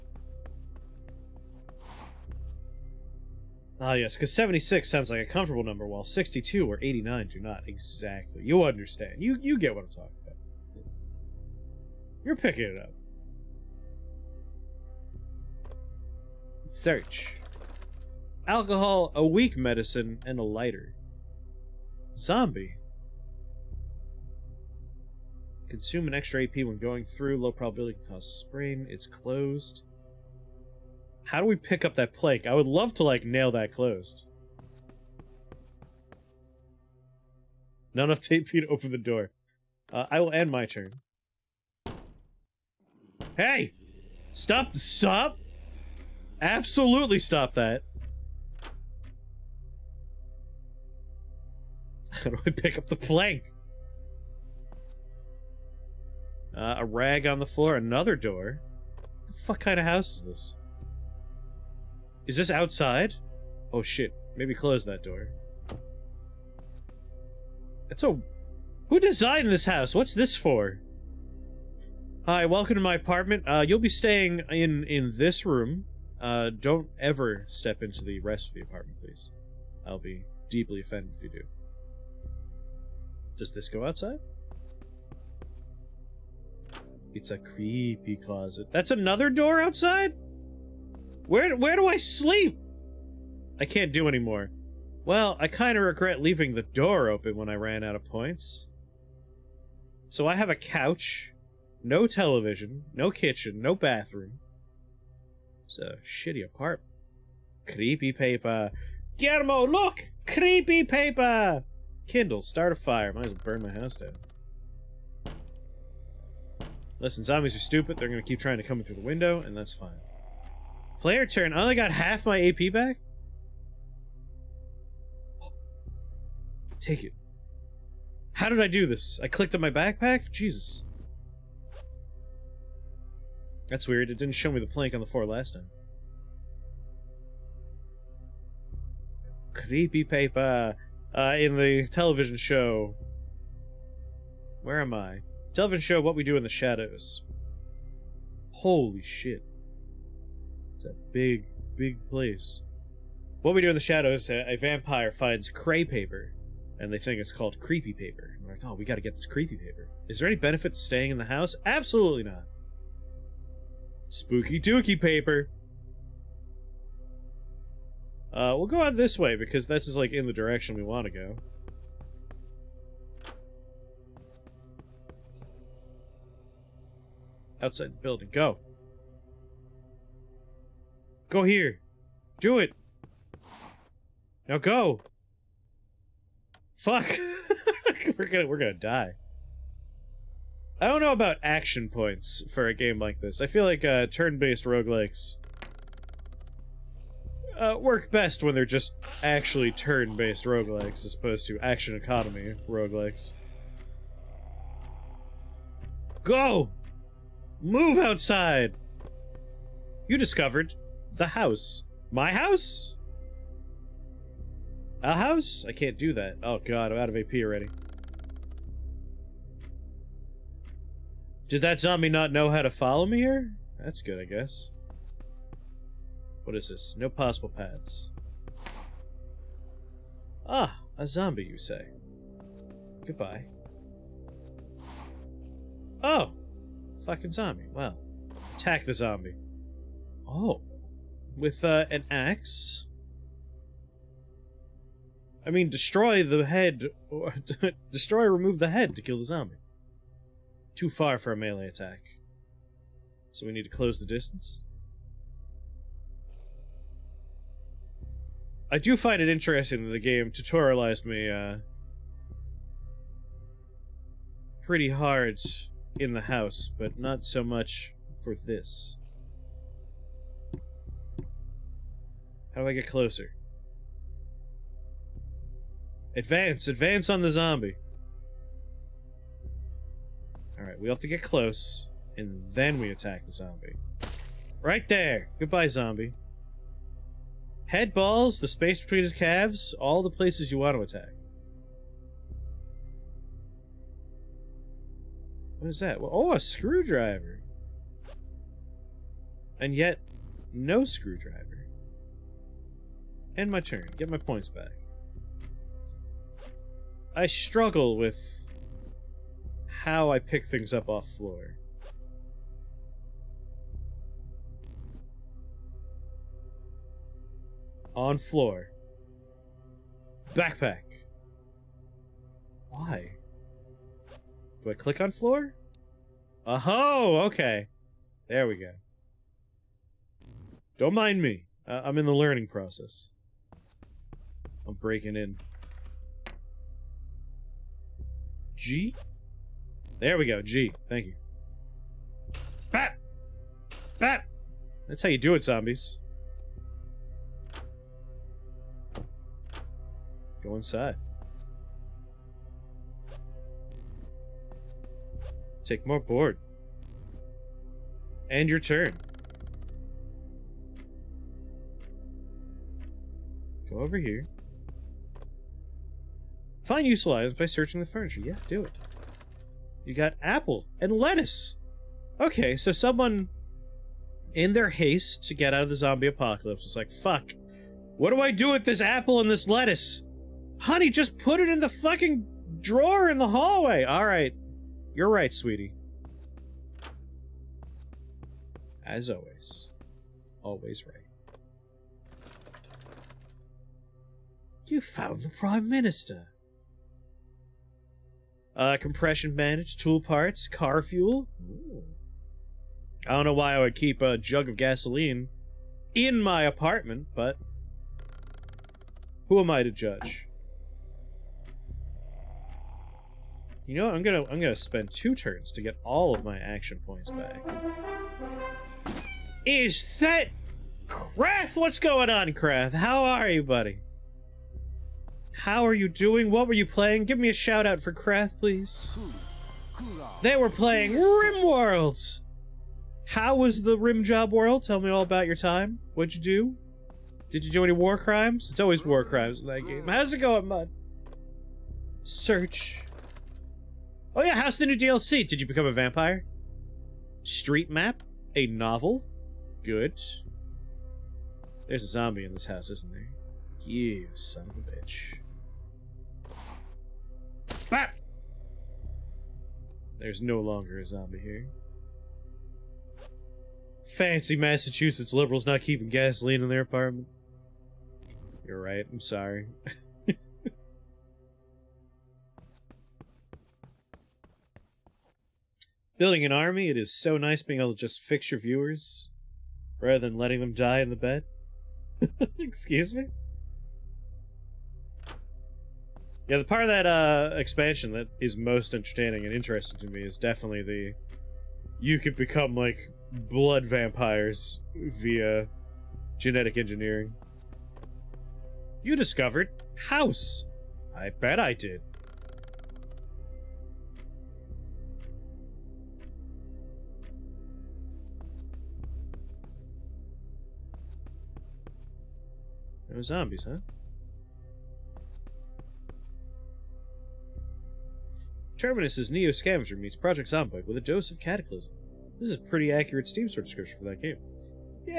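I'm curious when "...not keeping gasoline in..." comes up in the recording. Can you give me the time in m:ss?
7:45.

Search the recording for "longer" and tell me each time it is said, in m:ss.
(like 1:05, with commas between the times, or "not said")
7:40.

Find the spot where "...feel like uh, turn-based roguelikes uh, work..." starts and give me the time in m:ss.
3:13.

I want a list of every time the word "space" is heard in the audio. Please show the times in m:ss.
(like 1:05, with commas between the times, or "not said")
4:48.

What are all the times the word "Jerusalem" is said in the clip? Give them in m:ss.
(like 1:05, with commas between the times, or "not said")
not said.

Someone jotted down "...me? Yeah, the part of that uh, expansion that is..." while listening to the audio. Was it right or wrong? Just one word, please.
right.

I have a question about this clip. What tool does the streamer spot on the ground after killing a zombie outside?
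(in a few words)
A screwdriver.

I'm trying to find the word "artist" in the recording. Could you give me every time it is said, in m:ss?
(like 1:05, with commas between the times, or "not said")
not said.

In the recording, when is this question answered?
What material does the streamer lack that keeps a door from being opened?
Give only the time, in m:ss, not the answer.
0:38.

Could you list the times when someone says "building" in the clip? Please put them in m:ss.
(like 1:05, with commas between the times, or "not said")
2:58, 7:55.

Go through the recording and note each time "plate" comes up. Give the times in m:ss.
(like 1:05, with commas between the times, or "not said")
not said.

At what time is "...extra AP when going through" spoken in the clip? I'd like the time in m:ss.
0:26.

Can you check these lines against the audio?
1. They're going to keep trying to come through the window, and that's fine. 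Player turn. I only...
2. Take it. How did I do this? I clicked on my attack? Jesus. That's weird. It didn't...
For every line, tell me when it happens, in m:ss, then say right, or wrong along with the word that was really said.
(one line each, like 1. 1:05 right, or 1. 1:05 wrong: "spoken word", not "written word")
1. 1:57 right
2. 2:06 wrong: "backpack", not "attack".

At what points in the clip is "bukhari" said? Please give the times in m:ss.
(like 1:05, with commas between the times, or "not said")
not said.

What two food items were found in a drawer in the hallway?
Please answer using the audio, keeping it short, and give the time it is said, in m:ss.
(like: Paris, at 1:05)
Apple and lettuce, at 6:10.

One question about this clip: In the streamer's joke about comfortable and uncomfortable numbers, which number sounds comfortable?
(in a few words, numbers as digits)
76.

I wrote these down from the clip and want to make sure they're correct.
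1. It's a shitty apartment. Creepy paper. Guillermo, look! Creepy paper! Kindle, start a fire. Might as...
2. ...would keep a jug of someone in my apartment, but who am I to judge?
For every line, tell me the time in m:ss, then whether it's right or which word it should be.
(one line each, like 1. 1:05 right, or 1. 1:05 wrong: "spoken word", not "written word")
1. 1:45 right
2. 6:43 wrong: "gasoline", not "someone".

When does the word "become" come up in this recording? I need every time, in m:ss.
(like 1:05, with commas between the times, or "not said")
7:25, 8:12.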